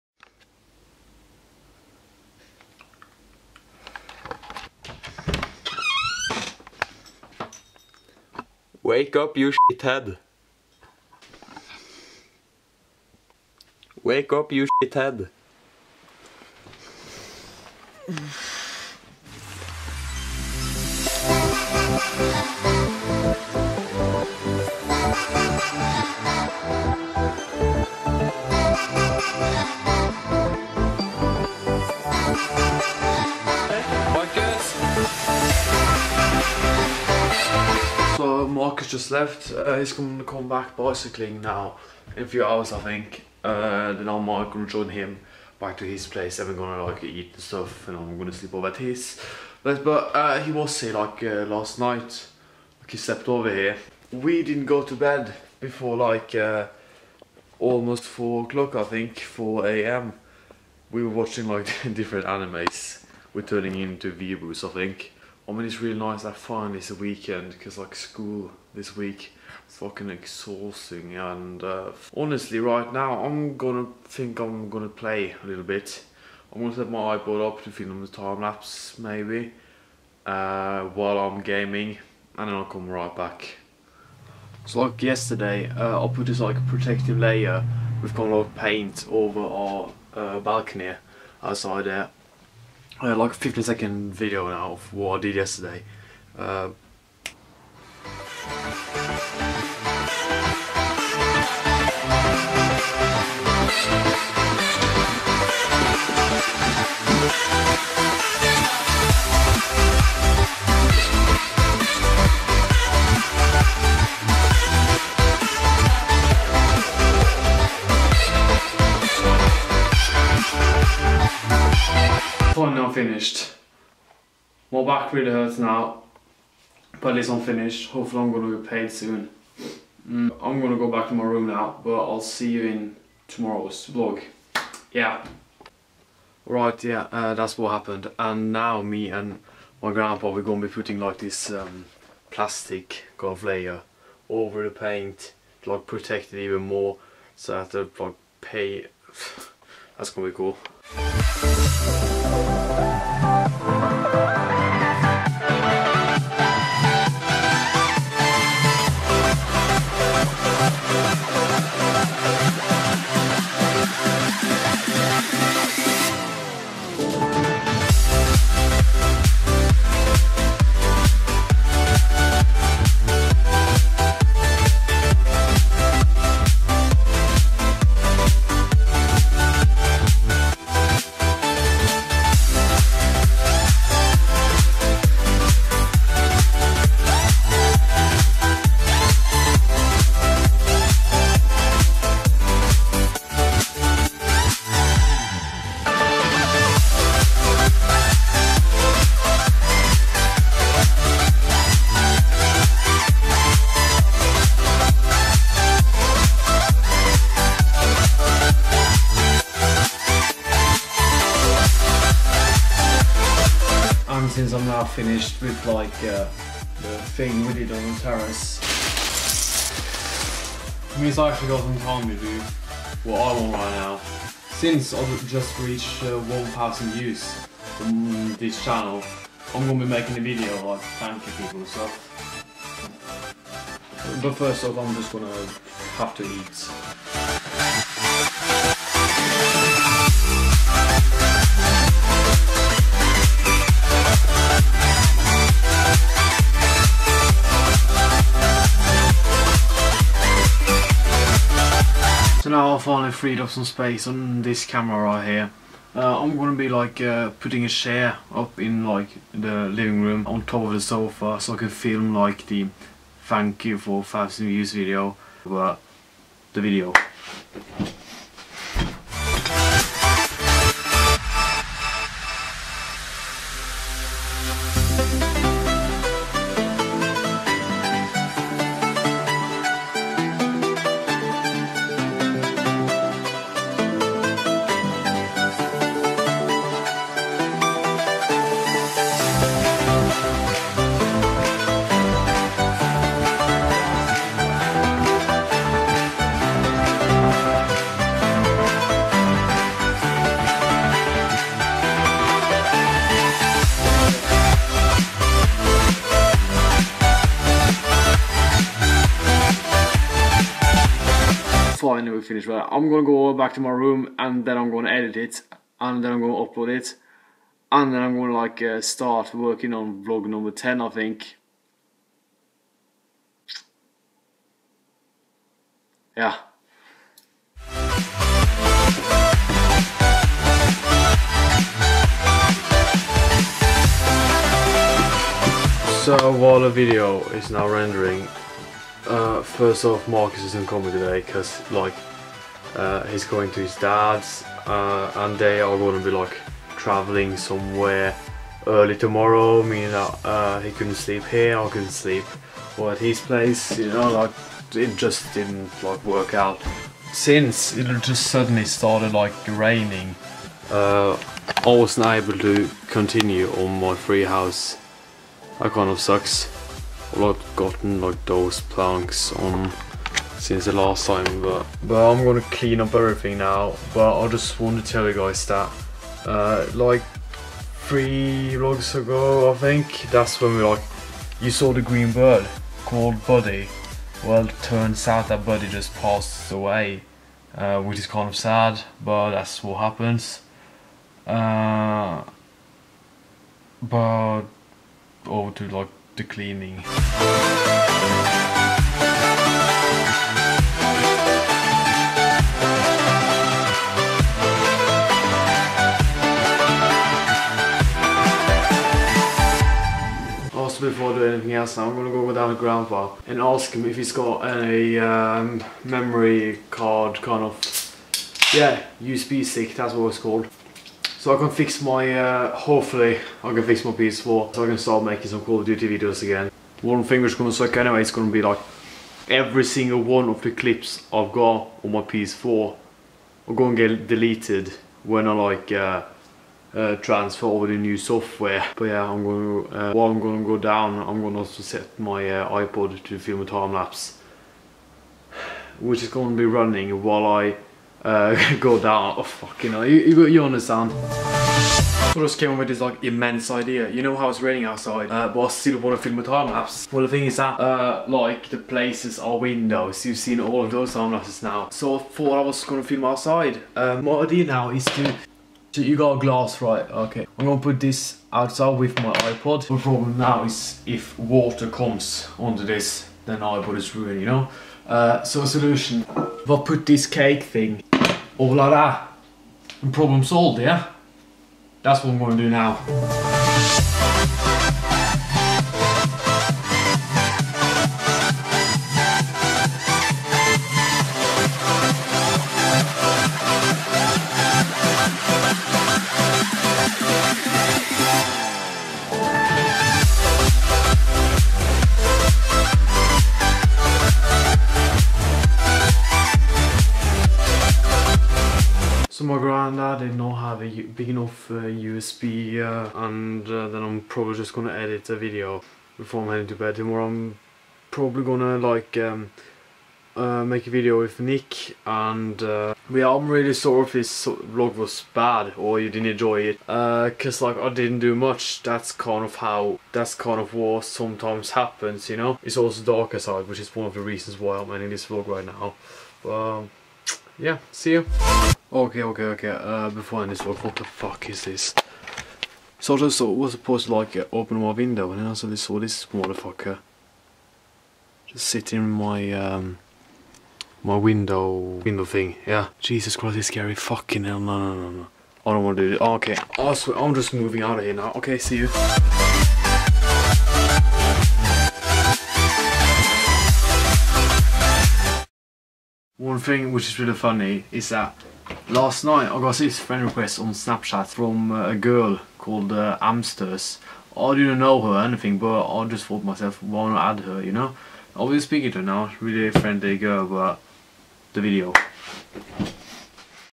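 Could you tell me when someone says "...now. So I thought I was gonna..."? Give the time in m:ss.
7:41.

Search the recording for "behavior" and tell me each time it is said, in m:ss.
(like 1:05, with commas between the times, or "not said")
not said.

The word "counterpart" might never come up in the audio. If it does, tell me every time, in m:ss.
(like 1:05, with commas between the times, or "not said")
not said.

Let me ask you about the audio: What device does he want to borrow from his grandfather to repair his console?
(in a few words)
USB stick.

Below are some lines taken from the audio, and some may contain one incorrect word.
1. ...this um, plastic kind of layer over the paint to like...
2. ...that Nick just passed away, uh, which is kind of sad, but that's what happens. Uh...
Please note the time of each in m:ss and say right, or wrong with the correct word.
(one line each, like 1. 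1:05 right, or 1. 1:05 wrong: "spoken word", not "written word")
1. 2:21 right
2. 6:25 wrong: "Buddy", not "Nick".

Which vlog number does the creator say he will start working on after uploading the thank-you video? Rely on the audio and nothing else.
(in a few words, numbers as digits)
10.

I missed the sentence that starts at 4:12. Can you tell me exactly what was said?
finally freed up some space on this camera right here.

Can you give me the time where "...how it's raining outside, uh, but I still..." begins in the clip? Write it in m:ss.
7:34.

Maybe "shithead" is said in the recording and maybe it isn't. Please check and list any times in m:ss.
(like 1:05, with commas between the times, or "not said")
0:09, 0:14.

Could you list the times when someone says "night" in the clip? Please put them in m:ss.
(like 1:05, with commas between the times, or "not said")
0:51, 9:29.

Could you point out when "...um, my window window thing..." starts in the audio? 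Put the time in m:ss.
9:09.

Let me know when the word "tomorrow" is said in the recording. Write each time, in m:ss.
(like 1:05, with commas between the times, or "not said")
2:13, 5:48, 8:36.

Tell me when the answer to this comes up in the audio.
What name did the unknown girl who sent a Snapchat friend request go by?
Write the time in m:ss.
9:33.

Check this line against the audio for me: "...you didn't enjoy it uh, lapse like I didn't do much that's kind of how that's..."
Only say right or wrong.
wrong.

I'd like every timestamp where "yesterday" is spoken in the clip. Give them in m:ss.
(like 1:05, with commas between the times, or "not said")
1:25, 1:35.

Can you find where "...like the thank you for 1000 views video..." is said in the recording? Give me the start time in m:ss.
4:22.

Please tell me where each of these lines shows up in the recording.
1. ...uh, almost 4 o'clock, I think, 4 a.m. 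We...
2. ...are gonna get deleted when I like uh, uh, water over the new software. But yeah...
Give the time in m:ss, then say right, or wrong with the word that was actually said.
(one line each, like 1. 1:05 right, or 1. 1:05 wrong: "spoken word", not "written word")
1. 0:56 right
2. 7:13 wrong: "transfer", not "water".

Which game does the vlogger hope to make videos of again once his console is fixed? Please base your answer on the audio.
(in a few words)
Call of Duty.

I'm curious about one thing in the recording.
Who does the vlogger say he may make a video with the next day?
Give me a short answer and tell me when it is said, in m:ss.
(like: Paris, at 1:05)
Nick, at 8:41.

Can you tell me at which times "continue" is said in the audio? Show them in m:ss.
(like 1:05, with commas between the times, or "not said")
6:02.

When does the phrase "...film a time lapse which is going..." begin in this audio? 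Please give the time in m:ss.
7:23.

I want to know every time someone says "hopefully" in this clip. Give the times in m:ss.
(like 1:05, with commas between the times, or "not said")
2:07, 7:02.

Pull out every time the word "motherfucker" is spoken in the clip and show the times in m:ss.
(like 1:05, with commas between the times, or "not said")
9:06.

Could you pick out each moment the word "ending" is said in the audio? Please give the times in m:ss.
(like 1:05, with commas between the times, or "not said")
8:54.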